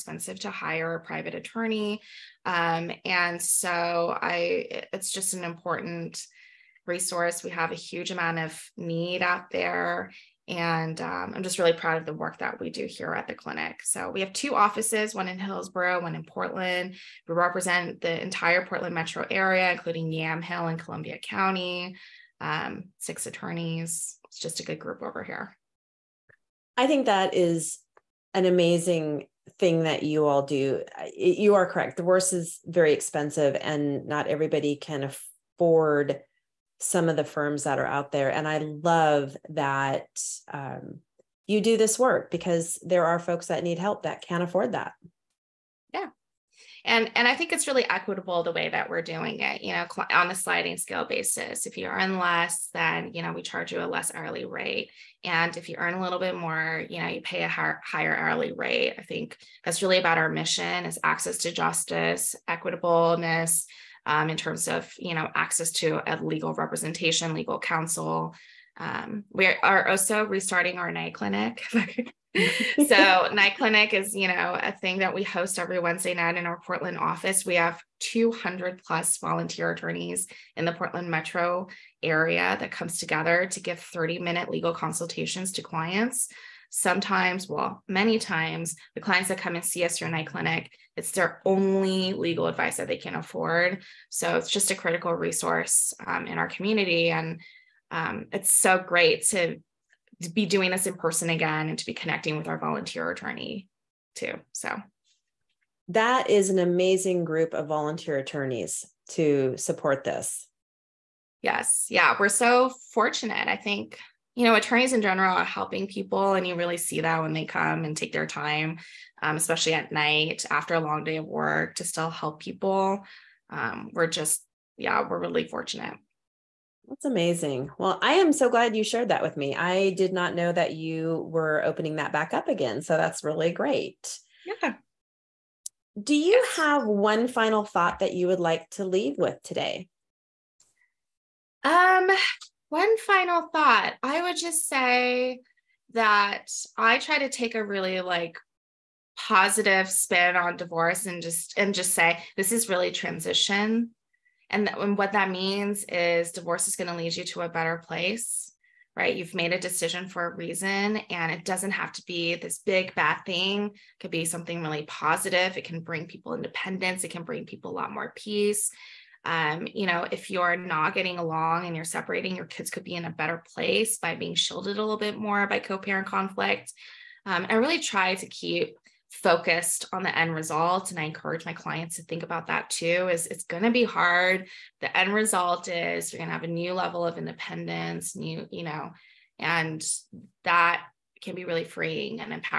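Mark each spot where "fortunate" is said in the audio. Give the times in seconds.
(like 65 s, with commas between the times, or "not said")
112 s, 125 s.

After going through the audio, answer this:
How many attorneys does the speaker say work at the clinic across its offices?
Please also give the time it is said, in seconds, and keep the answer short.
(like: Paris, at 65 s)
6, at 22 s.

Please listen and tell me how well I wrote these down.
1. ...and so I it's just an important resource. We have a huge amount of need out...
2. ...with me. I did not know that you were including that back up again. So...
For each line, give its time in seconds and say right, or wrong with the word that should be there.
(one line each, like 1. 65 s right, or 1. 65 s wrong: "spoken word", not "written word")
1. 3 s right
2. 129 s wrong: "opening", not "including".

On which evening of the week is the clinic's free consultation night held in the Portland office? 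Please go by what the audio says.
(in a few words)
Wednesday.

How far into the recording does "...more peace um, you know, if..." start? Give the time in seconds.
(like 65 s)
167 s.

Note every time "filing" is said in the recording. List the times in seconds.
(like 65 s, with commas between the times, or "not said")
not said.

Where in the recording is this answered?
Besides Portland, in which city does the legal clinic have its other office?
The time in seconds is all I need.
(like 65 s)
15 s.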